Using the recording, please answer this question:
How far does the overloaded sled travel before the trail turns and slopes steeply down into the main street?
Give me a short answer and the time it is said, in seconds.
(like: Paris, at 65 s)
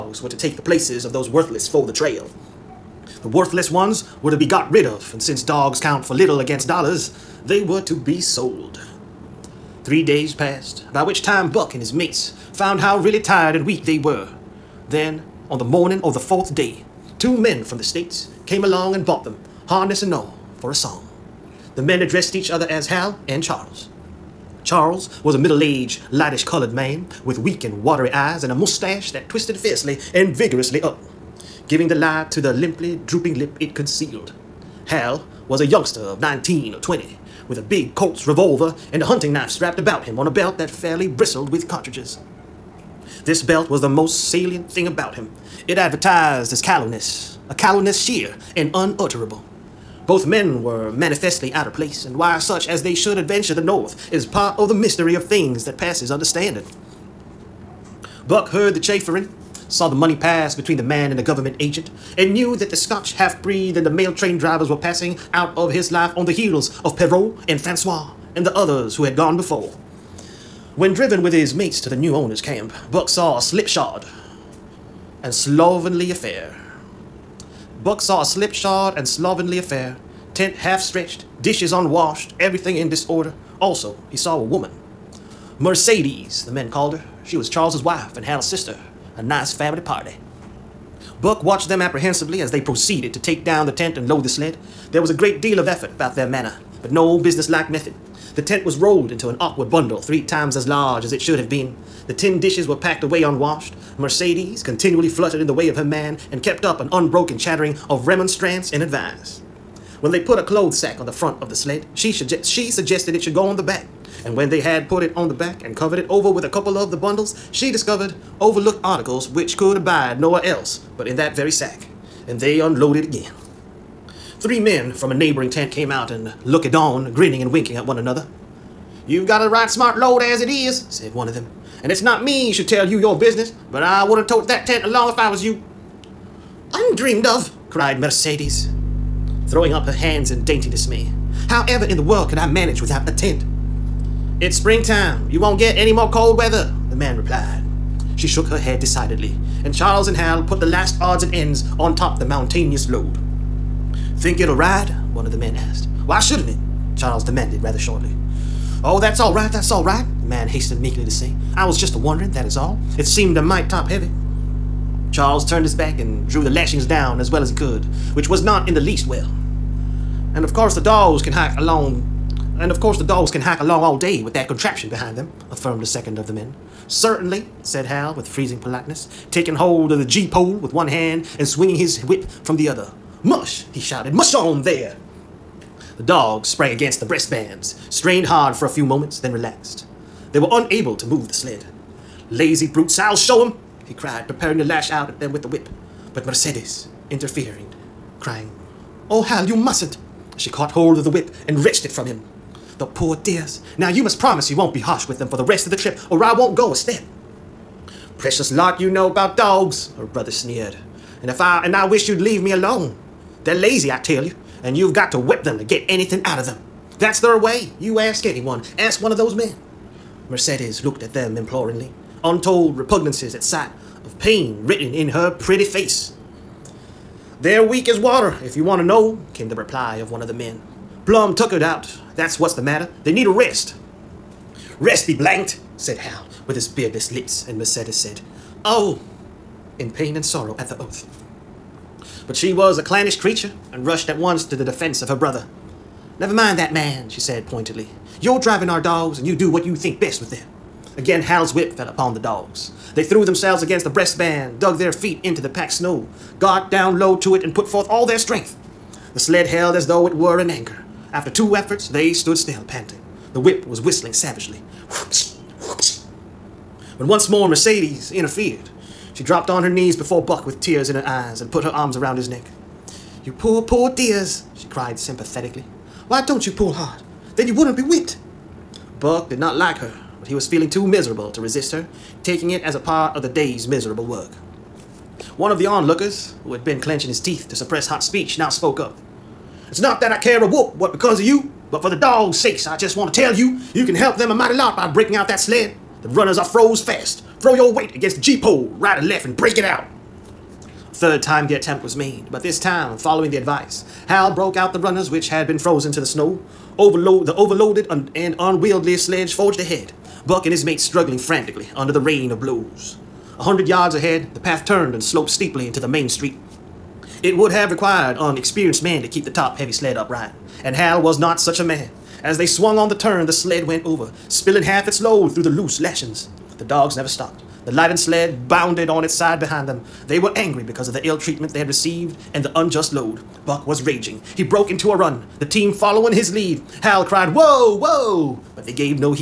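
100 yards, at 313 s.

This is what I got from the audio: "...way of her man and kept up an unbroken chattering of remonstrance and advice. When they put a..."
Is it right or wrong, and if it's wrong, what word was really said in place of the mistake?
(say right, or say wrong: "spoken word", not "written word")
right.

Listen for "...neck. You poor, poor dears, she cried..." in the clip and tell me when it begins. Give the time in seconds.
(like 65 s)
272 s.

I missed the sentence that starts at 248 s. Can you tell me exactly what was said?
You're driving our dogs and you do what you think best with them.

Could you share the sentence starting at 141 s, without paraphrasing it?
However in the world could I manage without a tent?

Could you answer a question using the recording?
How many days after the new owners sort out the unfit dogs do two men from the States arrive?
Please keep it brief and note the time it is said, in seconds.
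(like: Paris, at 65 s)
3, at 9 s.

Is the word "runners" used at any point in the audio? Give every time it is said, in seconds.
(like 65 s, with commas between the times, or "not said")
296 s, 304 s.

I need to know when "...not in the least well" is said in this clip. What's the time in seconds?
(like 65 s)
168 s.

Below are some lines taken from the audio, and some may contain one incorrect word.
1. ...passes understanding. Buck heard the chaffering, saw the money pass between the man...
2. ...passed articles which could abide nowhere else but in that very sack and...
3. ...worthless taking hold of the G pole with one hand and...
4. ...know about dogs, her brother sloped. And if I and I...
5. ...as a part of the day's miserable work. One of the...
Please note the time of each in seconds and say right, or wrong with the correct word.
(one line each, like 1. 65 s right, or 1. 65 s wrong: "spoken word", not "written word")
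1. 55 s right
2. 118 s wrong: "overlooked", not "passed"
3. 178 s wrong: "politeness", not "worthless"
4. 208 s wrong: "sneered", not "sloped"
5. 282 s right.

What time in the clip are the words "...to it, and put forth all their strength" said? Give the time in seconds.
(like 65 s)
257 s.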